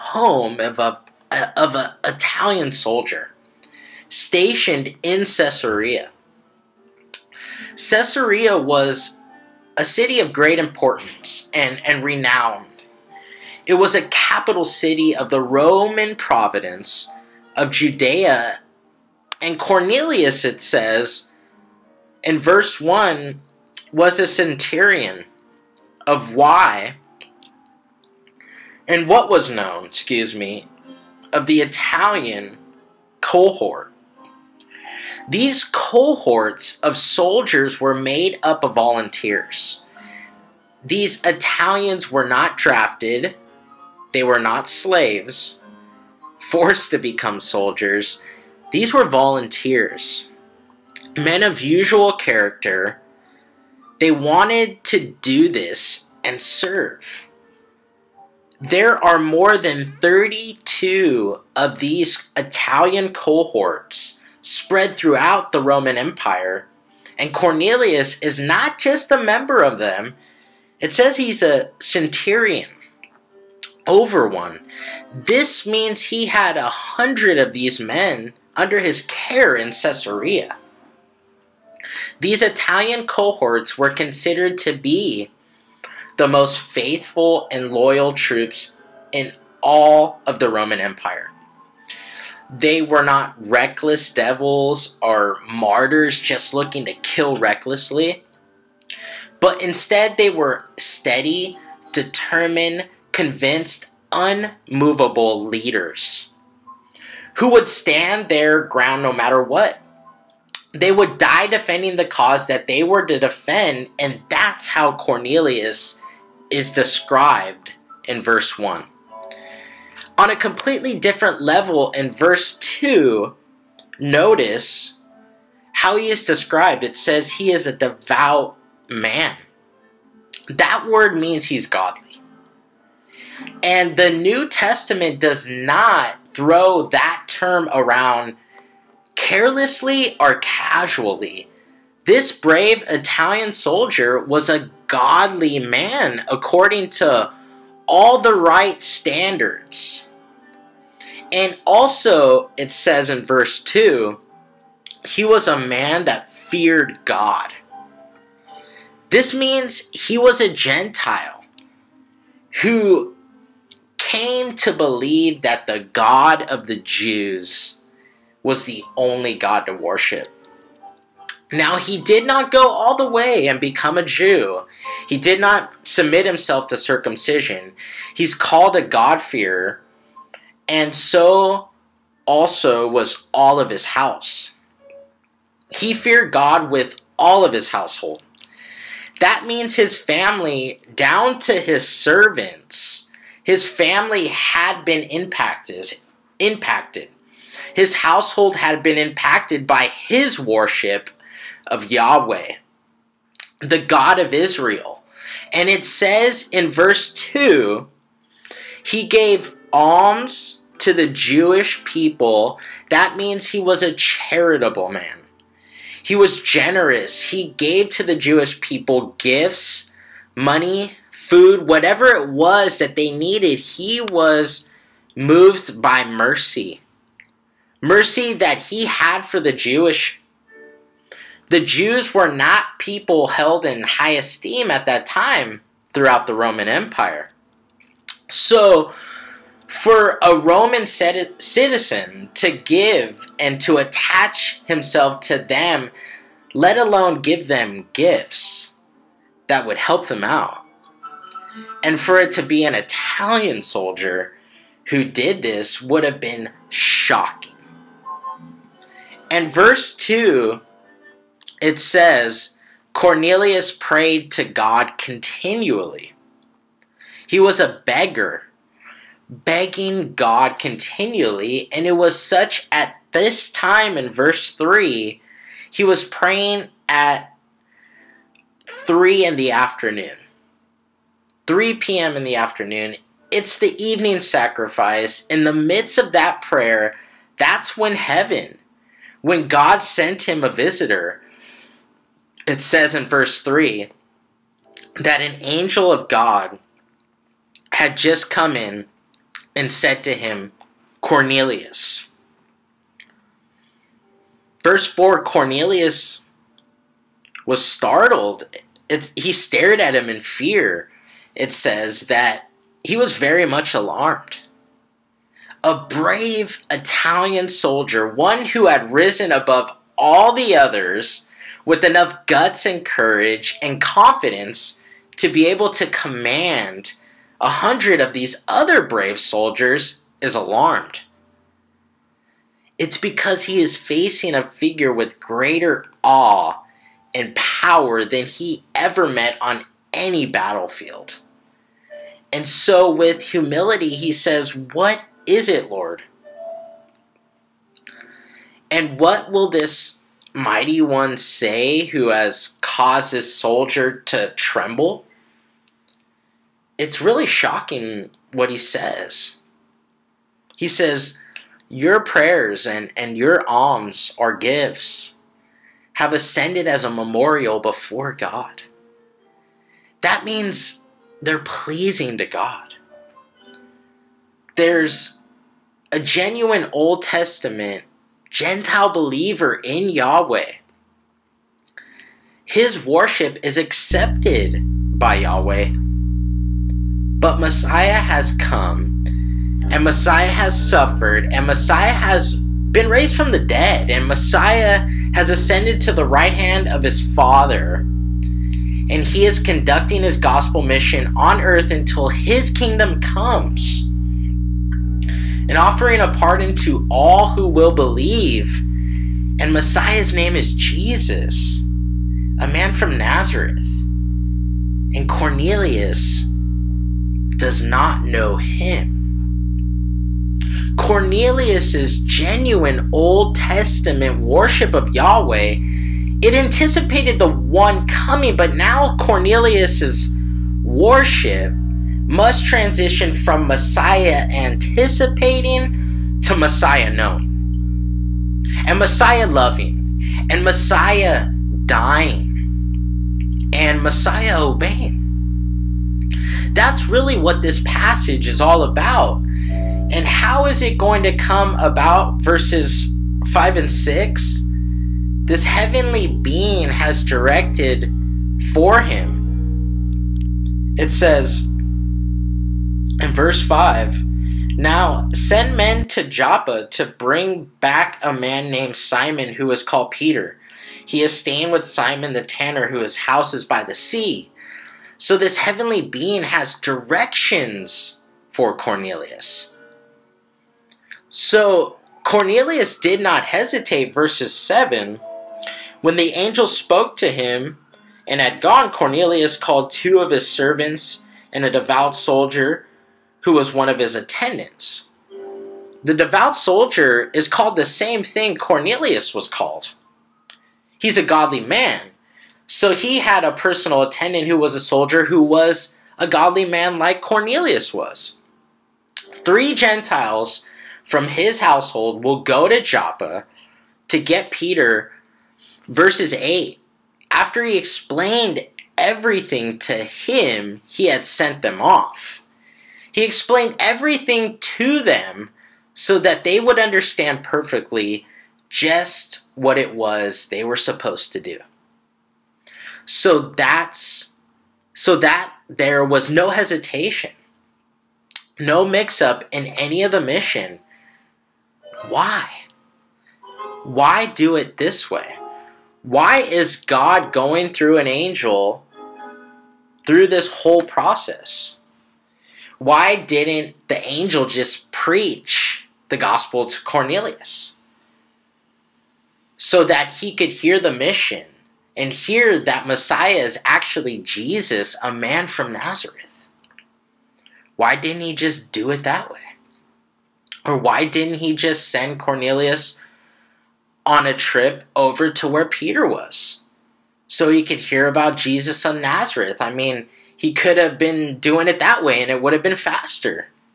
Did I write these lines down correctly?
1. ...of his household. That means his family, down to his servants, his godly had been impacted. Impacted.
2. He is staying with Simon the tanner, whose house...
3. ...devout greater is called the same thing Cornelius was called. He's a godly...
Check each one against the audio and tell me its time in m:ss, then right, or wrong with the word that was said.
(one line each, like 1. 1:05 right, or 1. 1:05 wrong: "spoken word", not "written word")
1. 3:07 wrong: "family", not "godly"
2. 7:50 right
3. 8:15 wrong: "soldier", not "greater".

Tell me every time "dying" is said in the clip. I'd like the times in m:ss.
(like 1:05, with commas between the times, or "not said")
7:21.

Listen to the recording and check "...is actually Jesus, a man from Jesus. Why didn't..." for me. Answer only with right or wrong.
wrong.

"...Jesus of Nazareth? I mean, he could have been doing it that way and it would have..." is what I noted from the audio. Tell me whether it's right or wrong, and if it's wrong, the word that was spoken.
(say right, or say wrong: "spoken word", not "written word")
right.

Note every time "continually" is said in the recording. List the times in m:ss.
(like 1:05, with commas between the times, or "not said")
4:24, 4:30.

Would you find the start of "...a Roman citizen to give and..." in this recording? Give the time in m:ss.
4:00.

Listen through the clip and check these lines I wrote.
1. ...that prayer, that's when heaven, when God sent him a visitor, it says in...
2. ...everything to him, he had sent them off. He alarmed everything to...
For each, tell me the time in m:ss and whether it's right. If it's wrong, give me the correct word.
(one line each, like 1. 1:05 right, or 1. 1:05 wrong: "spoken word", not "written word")
1. 4:46 right
2. 8:38 wrong: "explained", not "alarmed".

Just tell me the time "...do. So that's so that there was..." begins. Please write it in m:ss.
8:51.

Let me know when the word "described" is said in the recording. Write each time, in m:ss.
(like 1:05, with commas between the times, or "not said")
1:56, 2:06.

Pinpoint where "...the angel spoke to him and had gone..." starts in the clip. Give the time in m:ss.
8:05.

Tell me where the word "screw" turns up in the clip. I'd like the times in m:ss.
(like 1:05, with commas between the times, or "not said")
not said.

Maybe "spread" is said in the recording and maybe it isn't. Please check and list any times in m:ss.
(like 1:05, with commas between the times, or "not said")
1:04.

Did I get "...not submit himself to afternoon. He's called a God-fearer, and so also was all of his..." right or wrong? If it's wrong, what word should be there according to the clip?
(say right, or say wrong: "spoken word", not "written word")
wrong: "circumcision", not "afternoon".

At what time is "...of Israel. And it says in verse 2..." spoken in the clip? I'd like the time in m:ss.
3:24.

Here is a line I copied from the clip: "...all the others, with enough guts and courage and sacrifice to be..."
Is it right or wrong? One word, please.
wrong.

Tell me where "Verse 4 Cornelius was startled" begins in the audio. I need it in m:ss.
5:04.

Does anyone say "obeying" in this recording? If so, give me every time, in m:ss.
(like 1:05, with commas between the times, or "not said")
7:24.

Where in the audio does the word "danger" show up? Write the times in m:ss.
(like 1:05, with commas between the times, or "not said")
not said.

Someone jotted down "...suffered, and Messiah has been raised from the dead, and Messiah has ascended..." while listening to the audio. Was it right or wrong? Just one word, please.
right.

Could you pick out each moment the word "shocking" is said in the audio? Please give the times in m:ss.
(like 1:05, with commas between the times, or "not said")
4:16, 5:57.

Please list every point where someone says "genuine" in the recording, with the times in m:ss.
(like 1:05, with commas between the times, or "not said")
6:15, 7:01.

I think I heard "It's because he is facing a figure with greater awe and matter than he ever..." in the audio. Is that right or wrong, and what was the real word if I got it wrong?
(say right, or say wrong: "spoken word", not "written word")
wrong: "power", not "matter".